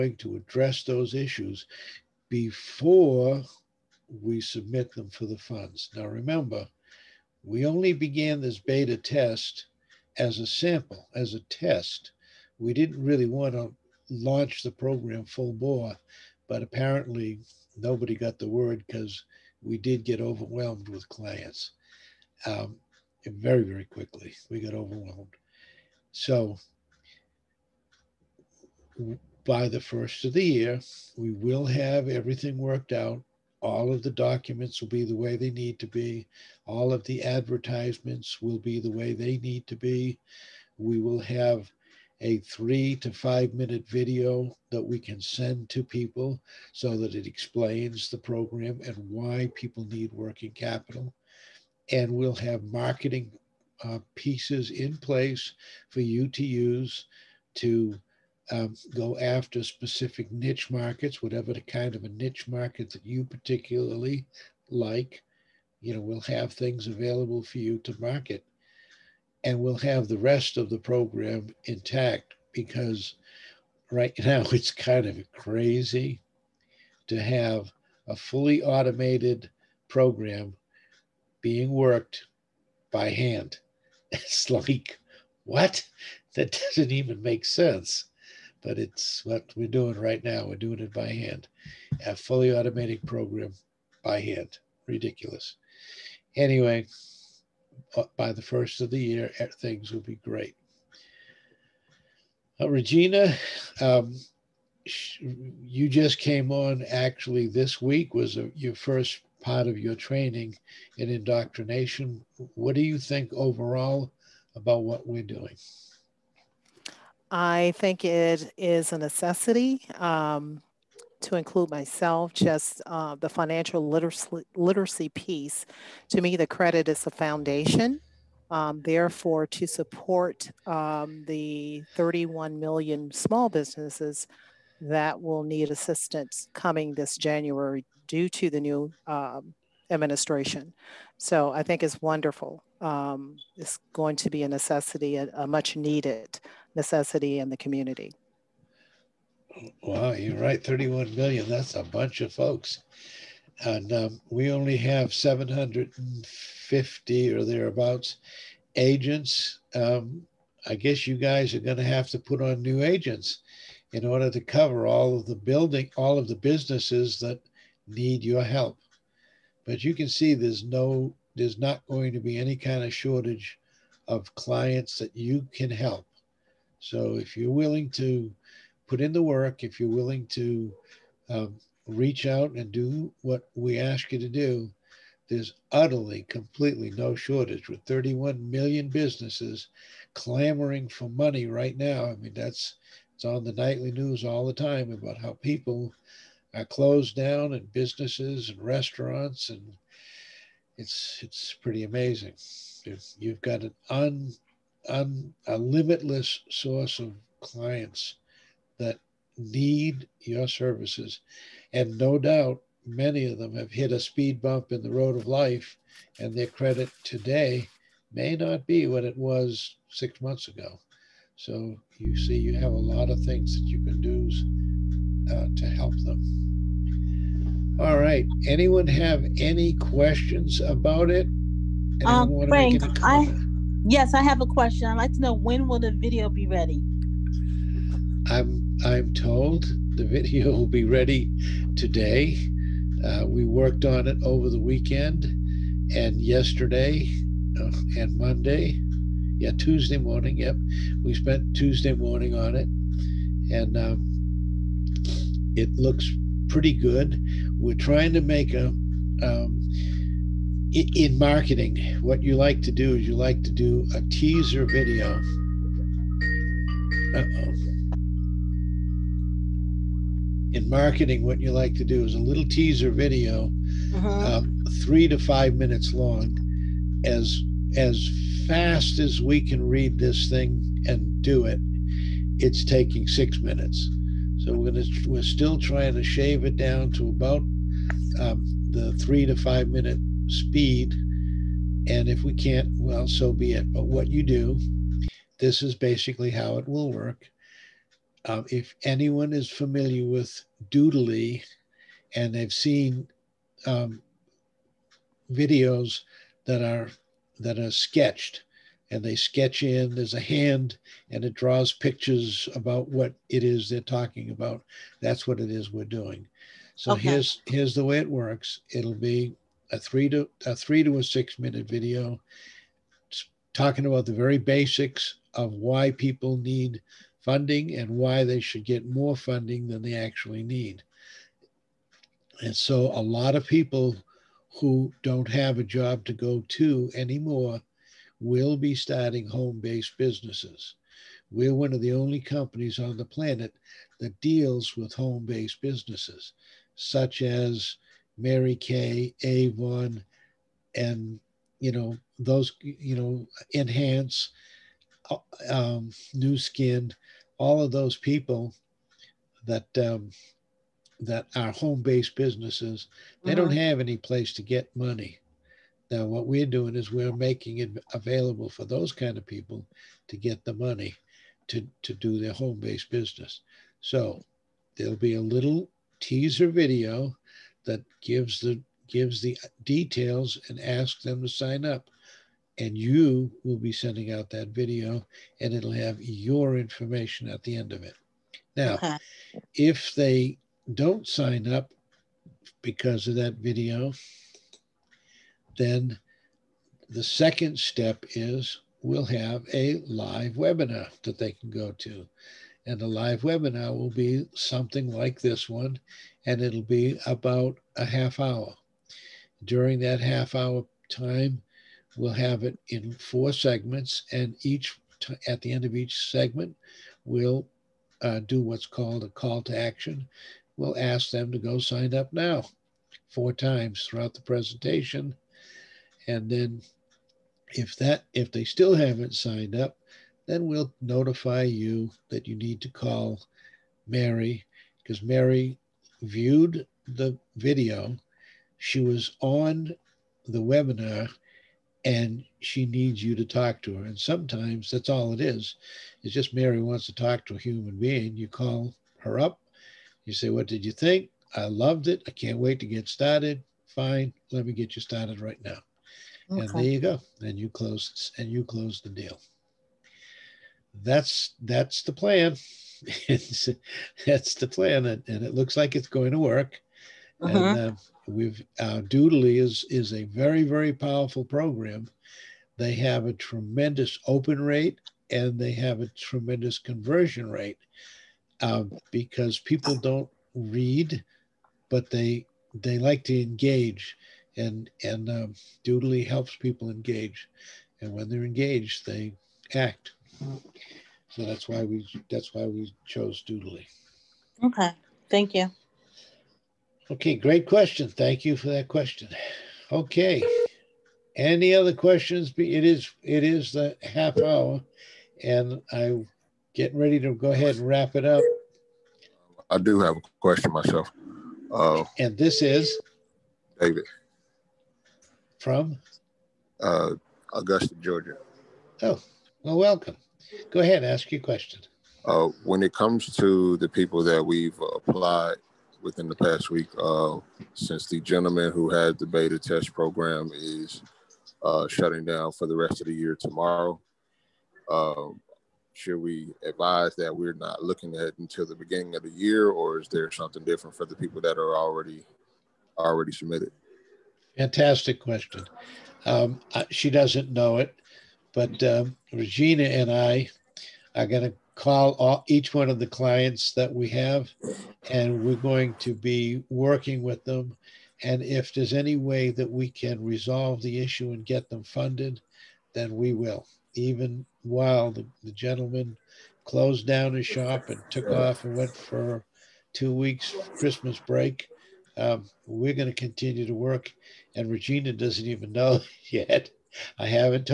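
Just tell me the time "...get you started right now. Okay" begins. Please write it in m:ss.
7:34.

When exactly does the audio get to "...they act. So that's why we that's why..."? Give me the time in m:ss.
8:08.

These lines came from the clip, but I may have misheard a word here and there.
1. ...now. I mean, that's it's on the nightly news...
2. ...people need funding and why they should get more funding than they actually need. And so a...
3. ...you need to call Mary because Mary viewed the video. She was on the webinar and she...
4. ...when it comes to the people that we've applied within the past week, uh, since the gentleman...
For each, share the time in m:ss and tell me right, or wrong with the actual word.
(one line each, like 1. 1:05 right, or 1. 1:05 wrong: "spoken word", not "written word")
1. 3:11 right
2. 5:25 right
3. 7:12 right
4. 8:42 right.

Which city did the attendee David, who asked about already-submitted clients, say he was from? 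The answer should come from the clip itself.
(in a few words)
Augusta, Georgia.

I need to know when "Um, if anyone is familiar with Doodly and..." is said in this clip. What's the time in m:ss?
4:58.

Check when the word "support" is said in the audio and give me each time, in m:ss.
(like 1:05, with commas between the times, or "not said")
2:09.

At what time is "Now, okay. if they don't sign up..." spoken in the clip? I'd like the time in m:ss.
6:28.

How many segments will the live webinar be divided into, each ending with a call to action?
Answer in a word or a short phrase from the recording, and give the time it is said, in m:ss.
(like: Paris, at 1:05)
4, at 6:52.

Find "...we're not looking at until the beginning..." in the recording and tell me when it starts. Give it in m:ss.
8:57.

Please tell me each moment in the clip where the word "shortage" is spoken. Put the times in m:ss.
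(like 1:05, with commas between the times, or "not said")
2:52, 3:07.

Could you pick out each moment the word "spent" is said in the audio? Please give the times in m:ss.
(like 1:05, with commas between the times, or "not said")
4:11.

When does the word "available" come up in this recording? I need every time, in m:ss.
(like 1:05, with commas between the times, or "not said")
1:06, 6:07.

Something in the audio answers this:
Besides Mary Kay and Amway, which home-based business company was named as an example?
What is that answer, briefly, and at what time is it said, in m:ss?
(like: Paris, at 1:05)
Nu Skin, at 5:56.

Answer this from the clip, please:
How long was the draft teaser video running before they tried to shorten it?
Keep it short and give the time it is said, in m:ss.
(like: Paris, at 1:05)
6 minutes, at 4:43.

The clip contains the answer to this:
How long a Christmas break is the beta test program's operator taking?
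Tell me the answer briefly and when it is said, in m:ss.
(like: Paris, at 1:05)
2 weeks, at 9:29.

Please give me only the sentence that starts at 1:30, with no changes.
We're doing it by hand, a fully automatic program by hand.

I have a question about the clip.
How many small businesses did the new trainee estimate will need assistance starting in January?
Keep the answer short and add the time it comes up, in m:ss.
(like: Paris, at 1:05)
31 million, at 2:11.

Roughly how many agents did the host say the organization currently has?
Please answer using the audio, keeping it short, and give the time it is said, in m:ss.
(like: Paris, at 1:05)
750, at 2:35.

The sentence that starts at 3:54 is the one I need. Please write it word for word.
I'd like to know when will the video be ready?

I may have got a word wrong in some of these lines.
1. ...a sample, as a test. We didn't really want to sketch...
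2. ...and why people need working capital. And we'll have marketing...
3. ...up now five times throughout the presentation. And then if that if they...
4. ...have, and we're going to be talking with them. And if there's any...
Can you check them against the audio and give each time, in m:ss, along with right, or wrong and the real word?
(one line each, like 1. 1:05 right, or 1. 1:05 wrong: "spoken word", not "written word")
1. 0:10 wrong: "launch", not "sketch"
2. 0:48 right
3. 7:01 wrong: "four", not "five"
4. 9:13 wrong: "working", not "talking".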